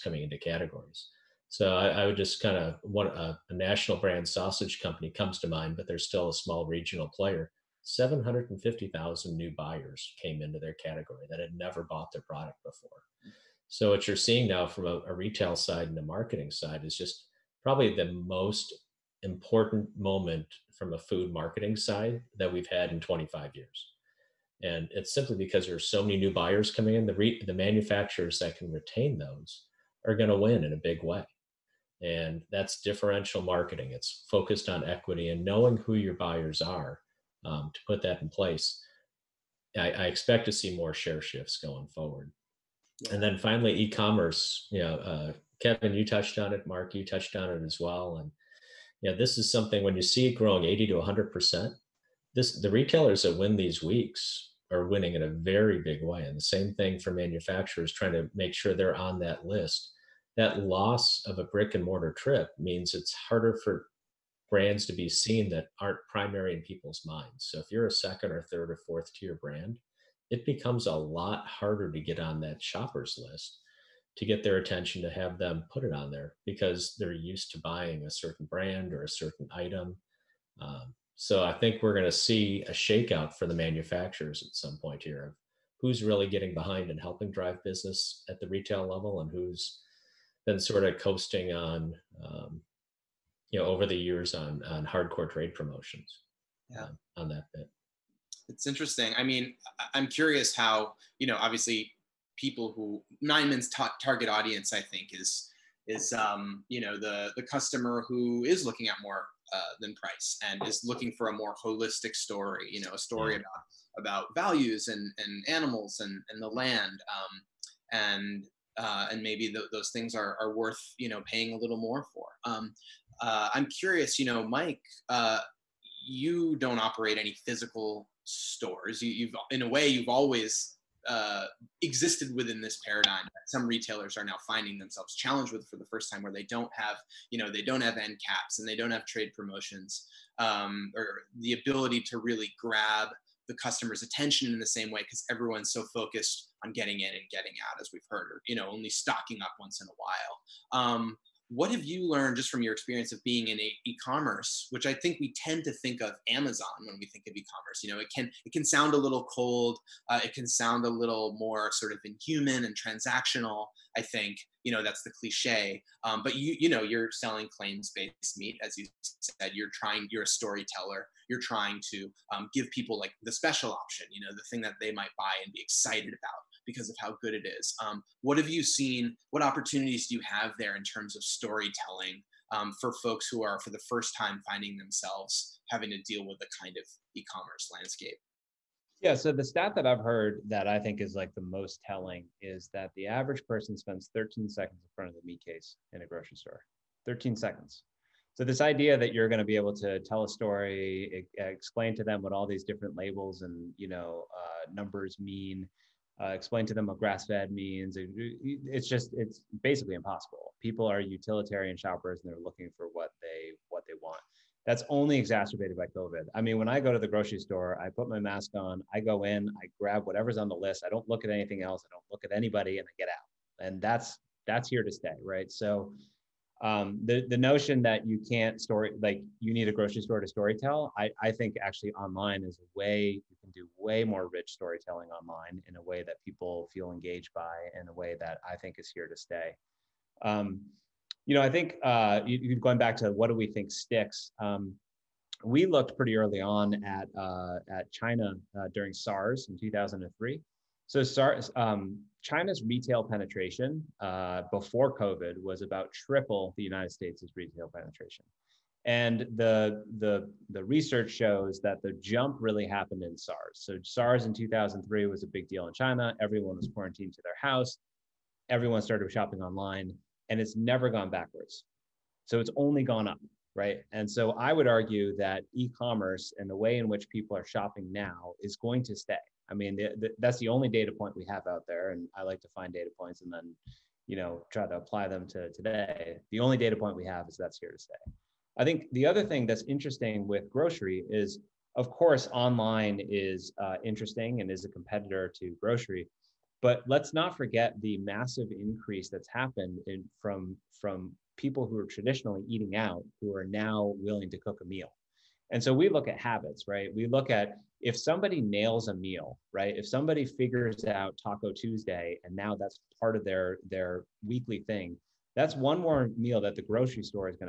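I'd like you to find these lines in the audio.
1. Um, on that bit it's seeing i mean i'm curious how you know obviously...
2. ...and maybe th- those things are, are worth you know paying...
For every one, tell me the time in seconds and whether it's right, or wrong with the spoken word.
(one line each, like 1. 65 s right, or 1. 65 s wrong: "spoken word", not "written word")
1. 96 s wrong: "interesting", not "seeing"
2. 119 s right.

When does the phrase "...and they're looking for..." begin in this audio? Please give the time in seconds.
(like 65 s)
212 s.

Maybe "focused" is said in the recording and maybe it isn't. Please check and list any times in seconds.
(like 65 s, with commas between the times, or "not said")
34 s, 145 s.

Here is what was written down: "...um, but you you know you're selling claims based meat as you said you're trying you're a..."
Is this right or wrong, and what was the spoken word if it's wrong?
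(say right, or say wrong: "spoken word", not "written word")
right.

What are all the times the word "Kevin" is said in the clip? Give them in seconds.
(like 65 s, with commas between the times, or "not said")
45 s.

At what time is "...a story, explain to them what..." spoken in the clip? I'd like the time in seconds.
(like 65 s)
200 s.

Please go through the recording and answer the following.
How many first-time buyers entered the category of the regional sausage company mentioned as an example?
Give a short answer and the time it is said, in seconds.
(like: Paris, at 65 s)
750,000, at 7 s.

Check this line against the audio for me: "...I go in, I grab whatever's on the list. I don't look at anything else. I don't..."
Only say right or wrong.
right.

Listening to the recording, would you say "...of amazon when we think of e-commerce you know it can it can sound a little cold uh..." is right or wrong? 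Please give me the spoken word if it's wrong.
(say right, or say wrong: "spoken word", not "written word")
right.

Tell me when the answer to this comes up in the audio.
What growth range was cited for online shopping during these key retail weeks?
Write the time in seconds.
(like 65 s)
50 s.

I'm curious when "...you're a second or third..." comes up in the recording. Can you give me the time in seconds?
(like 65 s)
67 s.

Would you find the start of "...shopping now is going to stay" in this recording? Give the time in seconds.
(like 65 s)
277 s.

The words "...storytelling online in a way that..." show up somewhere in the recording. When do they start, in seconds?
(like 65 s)
234 s.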